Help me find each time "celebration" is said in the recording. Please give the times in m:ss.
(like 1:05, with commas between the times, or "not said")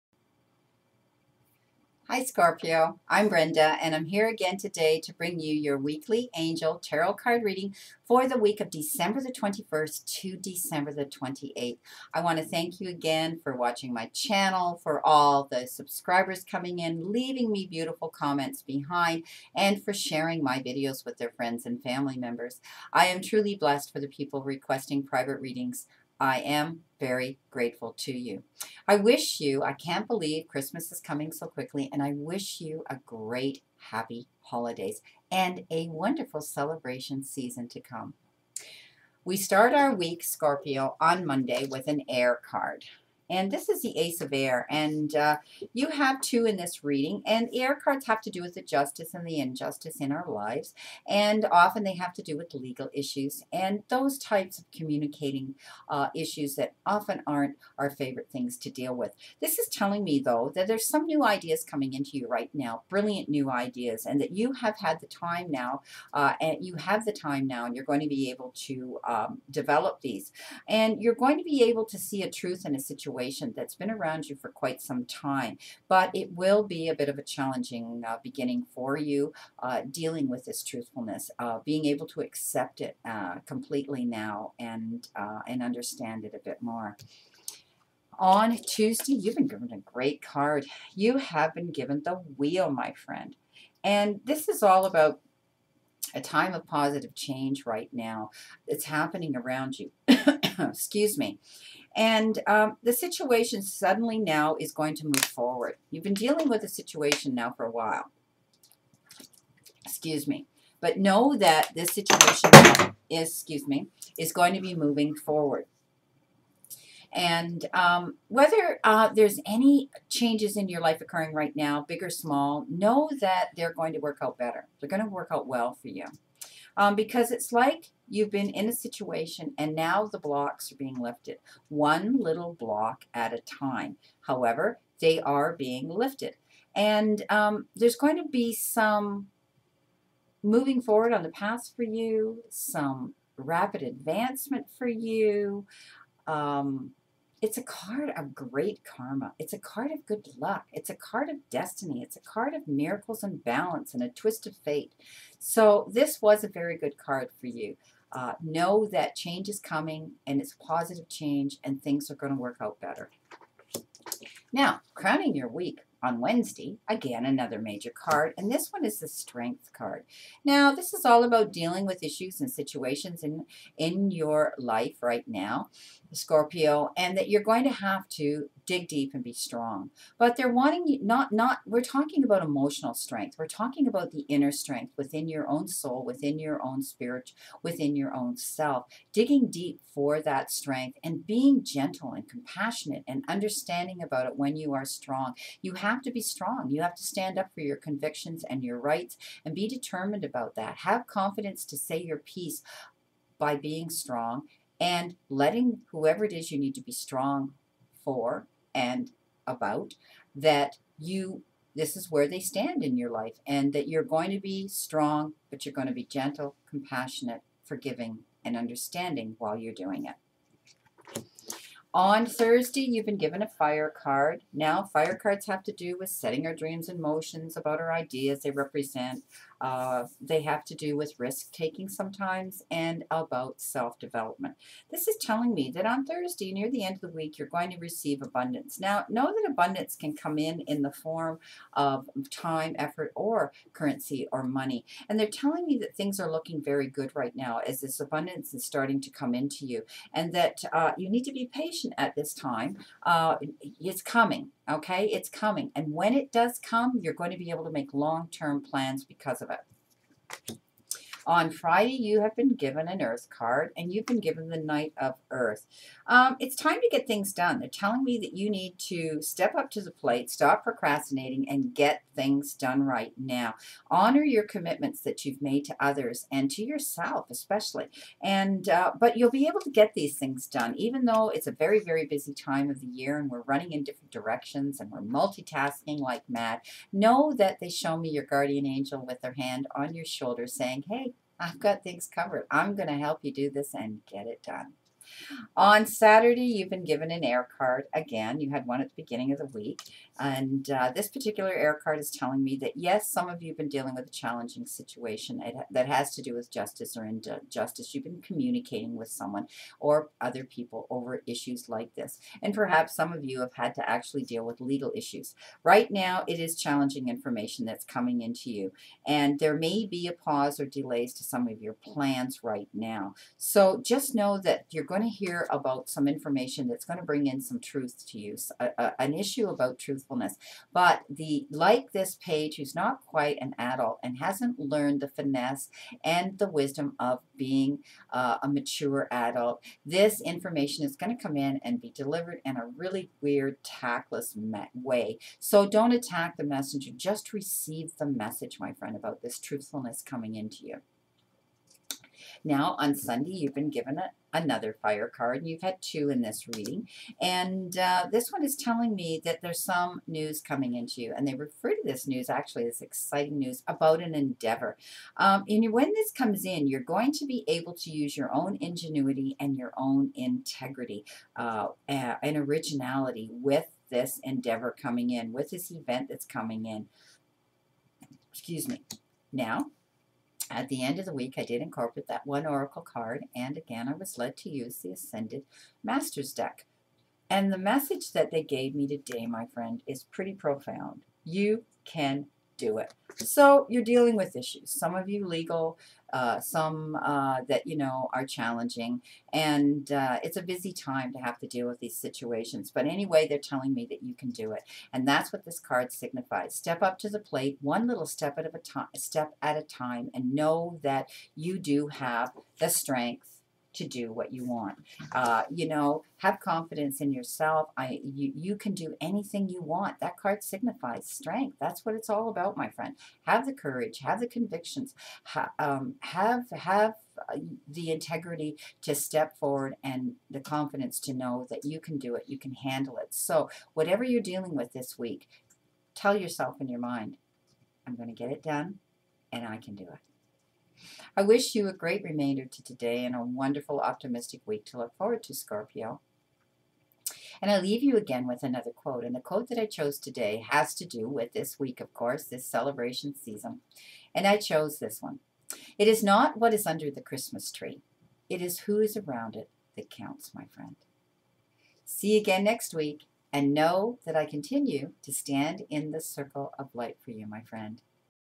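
0:36, 7:32.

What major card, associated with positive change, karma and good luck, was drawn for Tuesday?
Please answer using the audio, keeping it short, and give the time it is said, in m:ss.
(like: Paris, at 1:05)
The Wheel, at 1:32.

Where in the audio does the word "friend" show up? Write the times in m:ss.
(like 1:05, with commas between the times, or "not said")
0:21, 1:32, 5:48, 6:29, 7:02, 7:40, 7:47.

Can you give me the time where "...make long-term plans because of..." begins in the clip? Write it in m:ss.
4:17.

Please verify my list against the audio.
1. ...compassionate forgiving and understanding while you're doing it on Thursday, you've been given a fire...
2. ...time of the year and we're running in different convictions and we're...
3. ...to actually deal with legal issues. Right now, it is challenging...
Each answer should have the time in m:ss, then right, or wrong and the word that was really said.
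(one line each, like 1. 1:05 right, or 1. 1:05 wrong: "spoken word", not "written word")
1. 3:36 right
2. 4:42 wrong: "directions", not "convictions"
3. 5:13 right.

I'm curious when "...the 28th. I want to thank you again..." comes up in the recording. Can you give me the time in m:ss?
0:10.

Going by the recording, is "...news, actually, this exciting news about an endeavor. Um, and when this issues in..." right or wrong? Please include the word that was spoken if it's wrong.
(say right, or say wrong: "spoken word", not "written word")
wrong: "comes", not "issues".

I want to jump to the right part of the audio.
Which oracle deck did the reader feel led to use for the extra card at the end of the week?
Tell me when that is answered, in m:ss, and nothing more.
6:24.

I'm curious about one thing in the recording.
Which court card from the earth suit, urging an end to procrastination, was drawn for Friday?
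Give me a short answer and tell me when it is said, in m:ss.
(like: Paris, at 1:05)
Knight of Earth, at 4:24.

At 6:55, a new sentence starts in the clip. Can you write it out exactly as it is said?
Uh, you know, have confidence in yourself.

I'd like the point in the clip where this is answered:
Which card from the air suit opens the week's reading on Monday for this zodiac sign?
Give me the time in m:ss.
0:43.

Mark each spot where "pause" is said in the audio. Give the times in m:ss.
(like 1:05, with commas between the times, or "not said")
5:20.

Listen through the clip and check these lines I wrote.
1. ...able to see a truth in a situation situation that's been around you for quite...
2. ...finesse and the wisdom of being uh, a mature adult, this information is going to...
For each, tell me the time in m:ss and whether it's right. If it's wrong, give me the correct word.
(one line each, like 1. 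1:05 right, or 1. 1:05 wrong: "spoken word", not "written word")
1. 1:11 right
2. 5:35 right.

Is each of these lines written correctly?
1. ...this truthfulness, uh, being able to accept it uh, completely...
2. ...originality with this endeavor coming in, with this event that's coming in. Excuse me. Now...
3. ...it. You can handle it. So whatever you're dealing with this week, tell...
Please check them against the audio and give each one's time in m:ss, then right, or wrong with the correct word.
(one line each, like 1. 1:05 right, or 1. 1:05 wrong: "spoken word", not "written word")
1. 1:20 right
2. 6:12 right
3. 7:12 right.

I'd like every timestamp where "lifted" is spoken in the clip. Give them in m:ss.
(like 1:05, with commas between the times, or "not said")
2:10, 2:15.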